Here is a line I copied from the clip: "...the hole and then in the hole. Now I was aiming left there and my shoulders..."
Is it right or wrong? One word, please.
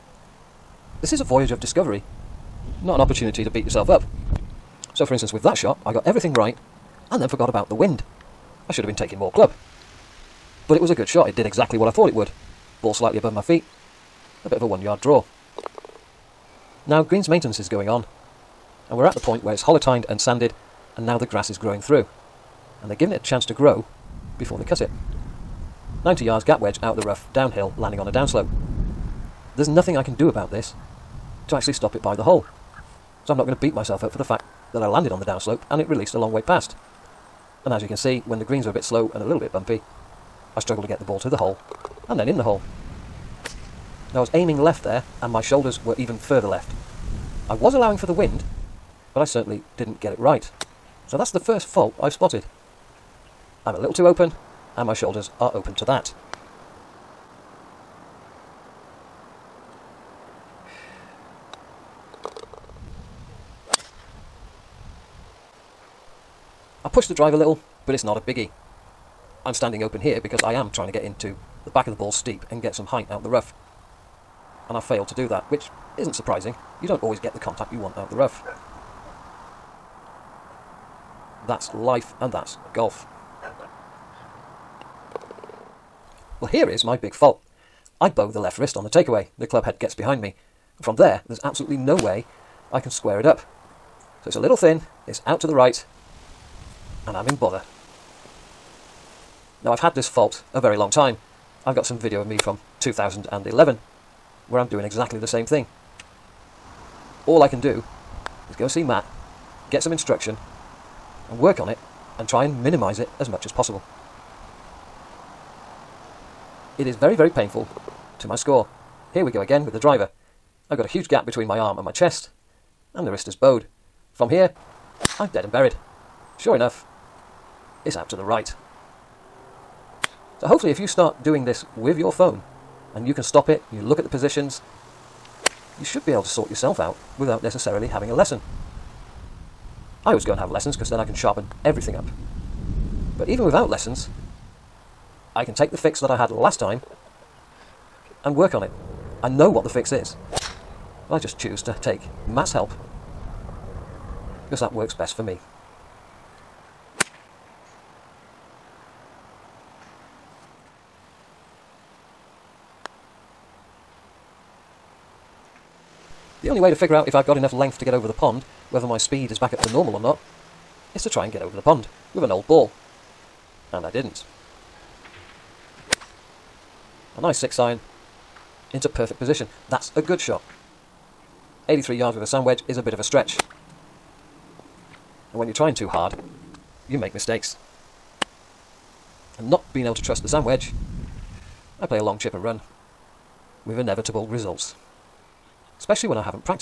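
right.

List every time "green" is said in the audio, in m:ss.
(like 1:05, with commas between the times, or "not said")
0:17, 0:38.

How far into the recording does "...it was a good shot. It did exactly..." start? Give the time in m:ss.
0:10.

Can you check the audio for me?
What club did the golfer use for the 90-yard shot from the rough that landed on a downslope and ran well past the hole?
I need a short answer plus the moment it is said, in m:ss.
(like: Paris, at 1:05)
Gap wedge, at 0:26.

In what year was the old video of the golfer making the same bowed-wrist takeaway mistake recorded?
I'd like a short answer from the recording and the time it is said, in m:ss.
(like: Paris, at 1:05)
2011, at 1:42.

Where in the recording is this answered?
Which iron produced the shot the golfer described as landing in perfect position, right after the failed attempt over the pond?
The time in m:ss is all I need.
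2:57.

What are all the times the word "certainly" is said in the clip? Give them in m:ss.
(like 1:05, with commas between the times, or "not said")
0:49.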